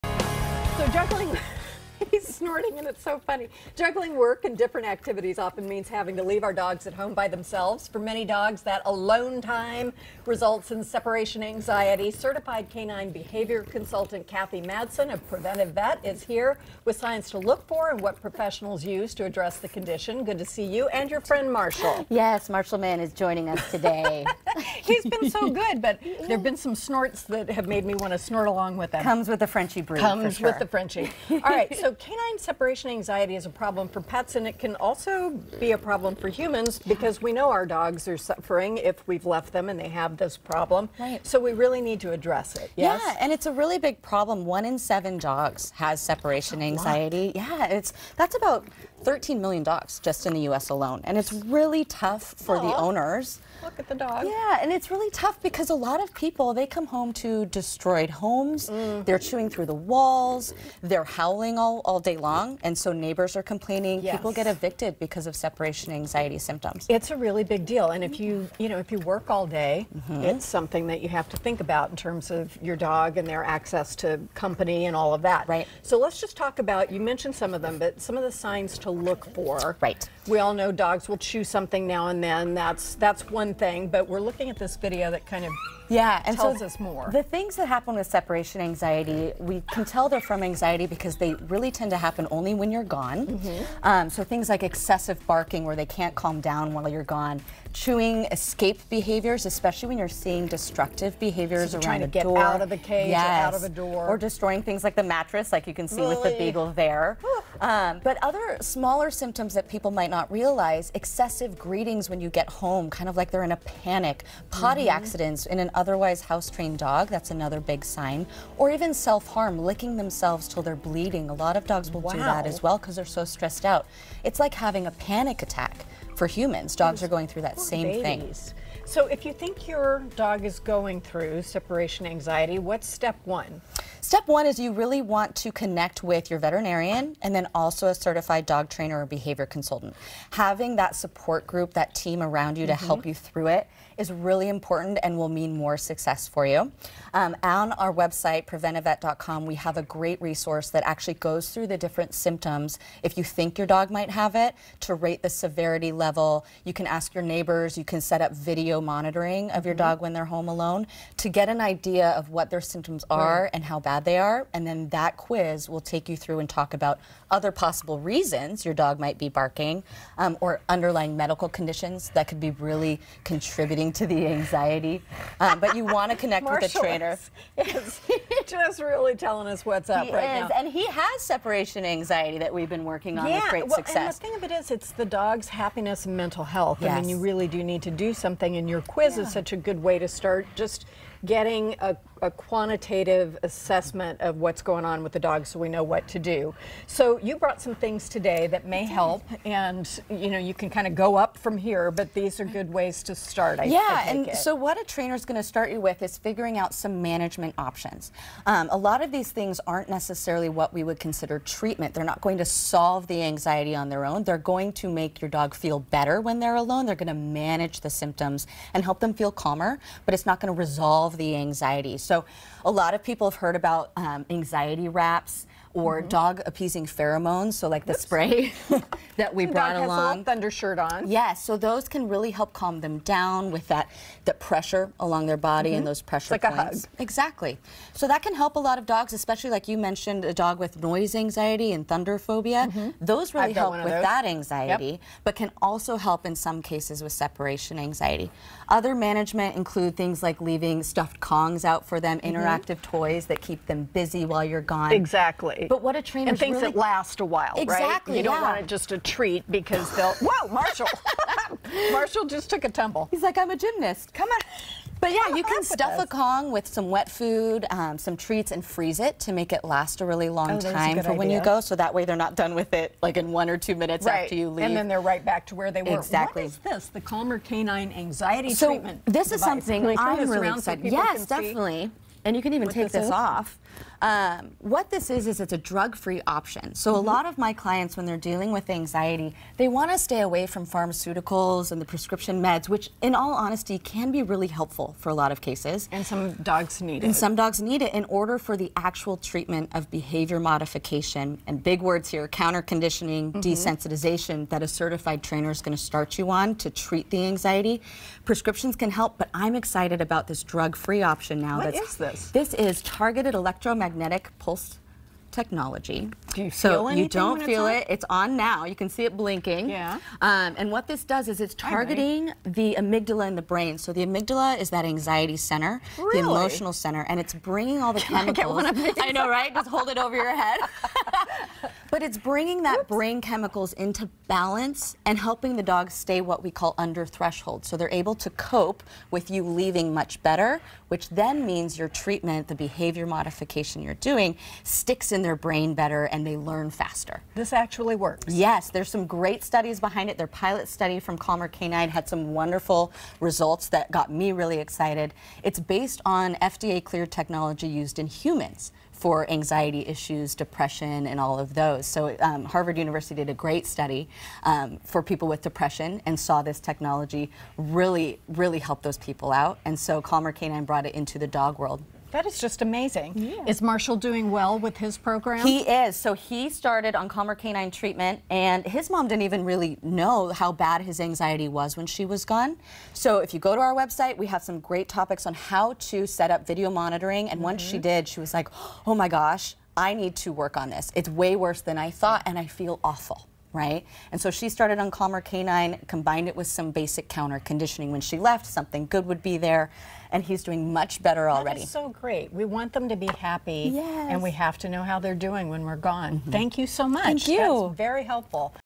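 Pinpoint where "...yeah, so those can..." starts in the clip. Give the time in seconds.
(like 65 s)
231 s.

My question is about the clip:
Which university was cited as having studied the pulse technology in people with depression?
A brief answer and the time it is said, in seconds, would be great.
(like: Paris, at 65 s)
Harvard University, at 362 s.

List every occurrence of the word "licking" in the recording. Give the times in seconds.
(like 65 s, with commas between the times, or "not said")
119 s.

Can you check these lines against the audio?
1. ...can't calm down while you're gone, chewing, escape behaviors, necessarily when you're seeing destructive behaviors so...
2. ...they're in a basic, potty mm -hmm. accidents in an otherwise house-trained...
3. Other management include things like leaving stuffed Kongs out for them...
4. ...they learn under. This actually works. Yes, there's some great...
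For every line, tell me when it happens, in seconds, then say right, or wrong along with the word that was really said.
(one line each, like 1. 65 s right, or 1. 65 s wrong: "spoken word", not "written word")
1. 95 s wrong: "especially", not "necessarily"
2. 113 s wrong: "panic", not "basic"
3. 248 s right
4. 346 s wrong: "faster", not "under".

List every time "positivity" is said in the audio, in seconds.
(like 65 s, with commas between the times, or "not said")
not said.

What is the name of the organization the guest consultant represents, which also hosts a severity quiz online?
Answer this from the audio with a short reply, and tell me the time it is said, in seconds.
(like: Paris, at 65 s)
Preventive Vet, at 15 s.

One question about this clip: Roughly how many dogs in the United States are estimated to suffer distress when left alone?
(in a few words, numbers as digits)
13 million.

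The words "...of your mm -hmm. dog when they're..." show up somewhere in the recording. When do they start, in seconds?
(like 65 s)
159 s.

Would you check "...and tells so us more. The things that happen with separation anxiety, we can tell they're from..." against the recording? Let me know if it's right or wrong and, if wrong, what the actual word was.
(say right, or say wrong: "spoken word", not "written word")
right.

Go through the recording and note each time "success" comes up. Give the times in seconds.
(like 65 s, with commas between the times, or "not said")
145 s, 183 s.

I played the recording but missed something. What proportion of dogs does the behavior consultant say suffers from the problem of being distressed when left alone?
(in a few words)
1 in 7.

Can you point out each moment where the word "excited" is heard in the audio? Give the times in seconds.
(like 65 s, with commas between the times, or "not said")
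280 s, 309 s, 354 s.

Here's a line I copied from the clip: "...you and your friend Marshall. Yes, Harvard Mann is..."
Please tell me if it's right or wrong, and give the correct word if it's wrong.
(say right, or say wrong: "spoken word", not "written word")
wrong: "Marshall", not "Harvard".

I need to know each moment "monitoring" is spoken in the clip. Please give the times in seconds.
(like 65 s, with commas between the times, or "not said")
158 s, 386 s.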